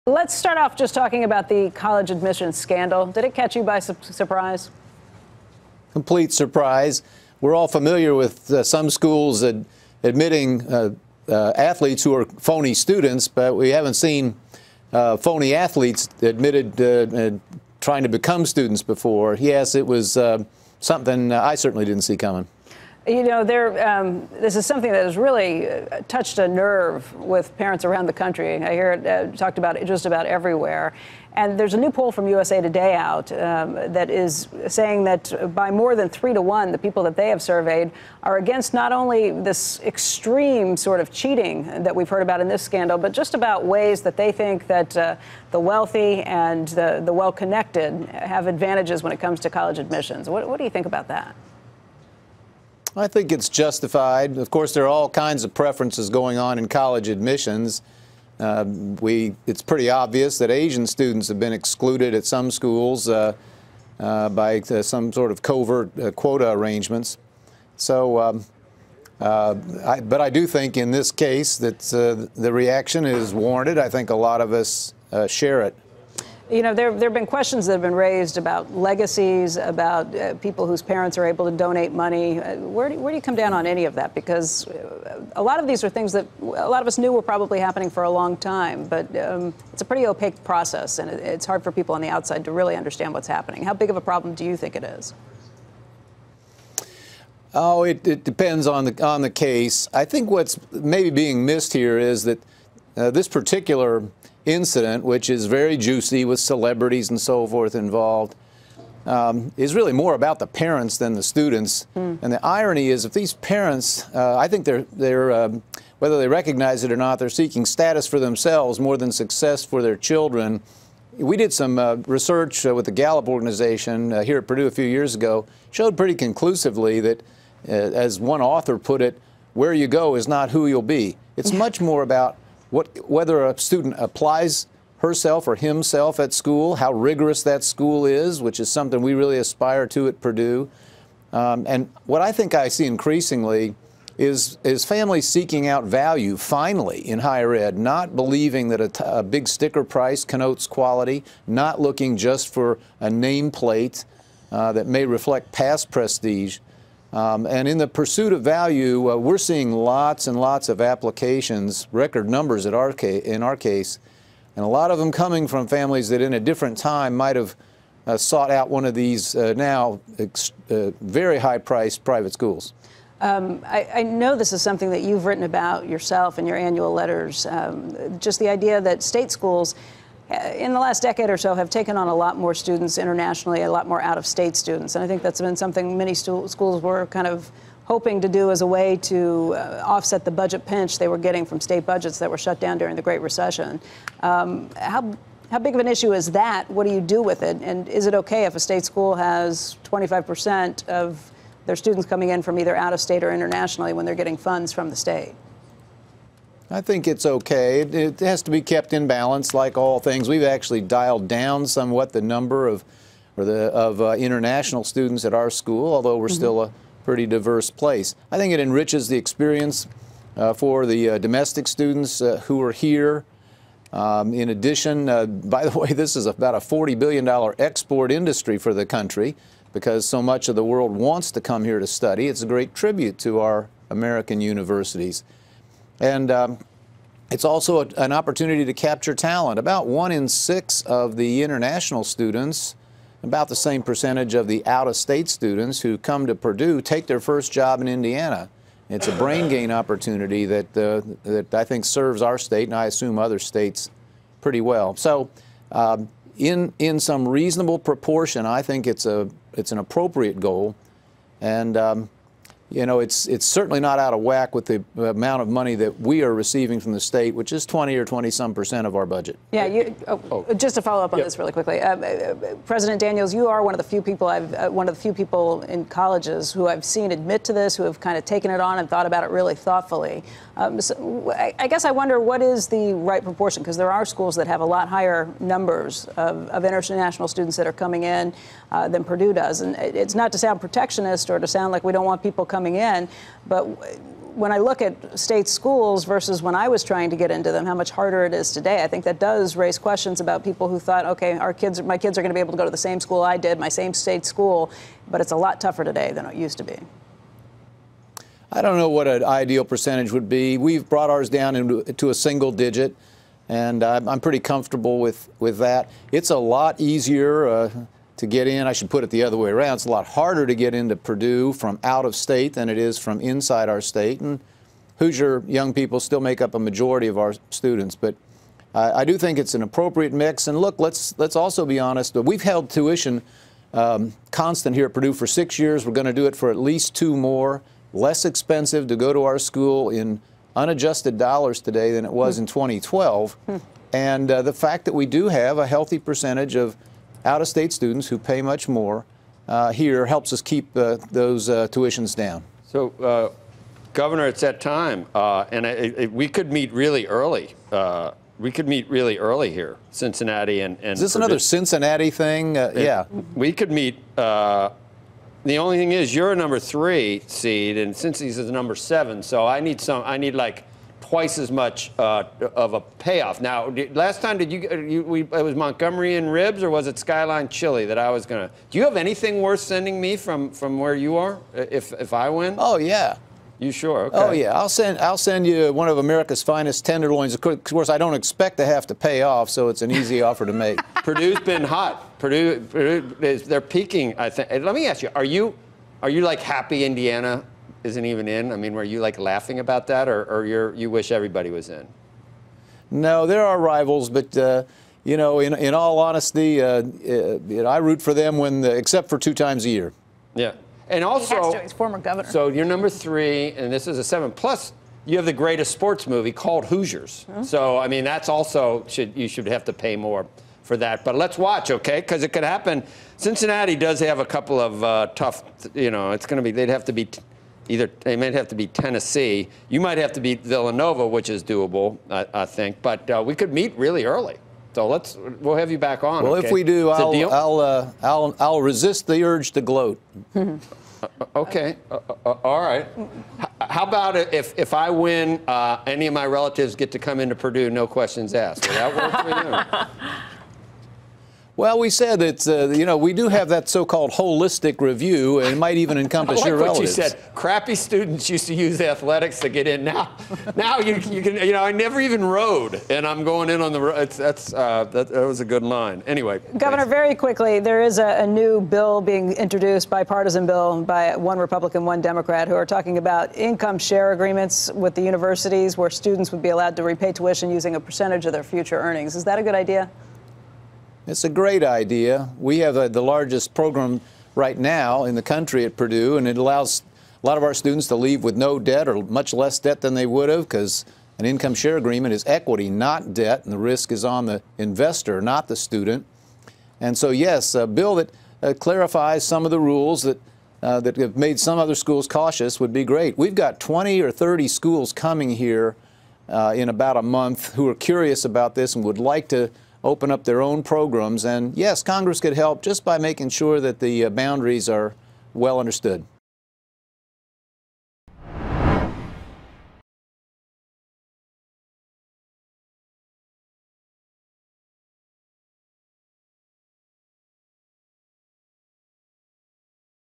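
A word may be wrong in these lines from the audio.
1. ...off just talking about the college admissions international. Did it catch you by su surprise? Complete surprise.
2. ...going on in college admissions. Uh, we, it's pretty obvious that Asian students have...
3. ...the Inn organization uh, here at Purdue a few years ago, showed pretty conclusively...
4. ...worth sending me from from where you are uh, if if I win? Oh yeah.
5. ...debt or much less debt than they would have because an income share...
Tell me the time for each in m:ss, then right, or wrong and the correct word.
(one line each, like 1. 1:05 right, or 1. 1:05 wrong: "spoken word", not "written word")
1. 0:00 wrong: "scandal", not "international"
2. 0:56 right
3. 2:02 wrong: "Gallup", not "Inn"
4. 6:19 right
5. 8:08 right.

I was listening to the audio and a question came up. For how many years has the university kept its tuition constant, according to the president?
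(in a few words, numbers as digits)
six years.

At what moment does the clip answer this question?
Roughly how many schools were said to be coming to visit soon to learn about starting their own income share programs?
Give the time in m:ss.
8:23.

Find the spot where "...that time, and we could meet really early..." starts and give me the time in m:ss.
5:54.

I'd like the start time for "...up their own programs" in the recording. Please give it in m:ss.
8:30.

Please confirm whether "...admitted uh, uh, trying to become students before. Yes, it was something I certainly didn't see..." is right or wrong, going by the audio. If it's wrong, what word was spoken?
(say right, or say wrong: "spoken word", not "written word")
right.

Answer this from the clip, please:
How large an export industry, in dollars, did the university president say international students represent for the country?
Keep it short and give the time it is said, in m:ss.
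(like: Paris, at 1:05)
$40 billion, at 3:46.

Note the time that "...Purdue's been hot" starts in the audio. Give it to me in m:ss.
6:31.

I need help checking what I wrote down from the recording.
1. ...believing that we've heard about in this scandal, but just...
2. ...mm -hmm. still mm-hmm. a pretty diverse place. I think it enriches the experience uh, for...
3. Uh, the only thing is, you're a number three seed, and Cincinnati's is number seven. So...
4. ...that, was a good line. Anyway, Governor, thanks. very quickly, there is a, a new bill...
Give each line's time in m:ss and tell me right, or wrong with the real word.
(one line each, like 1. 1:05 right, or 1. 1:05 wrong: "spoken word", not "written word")
1. 0:41 wrong: "cheating", not "believing"
2. 3:36 right
3. 6:04 right
4. 7:45 right.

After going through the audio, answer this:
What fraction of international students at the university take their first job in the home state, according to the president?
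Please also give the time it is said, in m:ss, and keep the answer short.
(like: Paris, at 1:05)
one in six, at 3:59.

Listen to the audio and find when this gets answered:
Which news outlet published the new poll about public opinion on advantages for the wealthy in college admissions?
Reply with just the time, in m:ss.
0:32.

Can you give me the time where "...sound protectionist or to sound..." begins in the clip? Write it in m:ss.
4:50.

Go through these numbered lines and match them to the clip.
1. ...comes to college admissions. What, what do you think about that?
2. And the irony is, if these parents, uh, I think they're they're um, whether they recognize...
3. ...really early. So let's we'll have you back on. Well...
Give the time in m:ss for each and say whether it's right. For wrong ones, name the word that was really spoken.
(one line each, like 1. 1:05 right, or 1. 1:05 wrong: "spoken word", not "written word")
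1. 0:49 right
2. 1:52 right
3. 7:13 right.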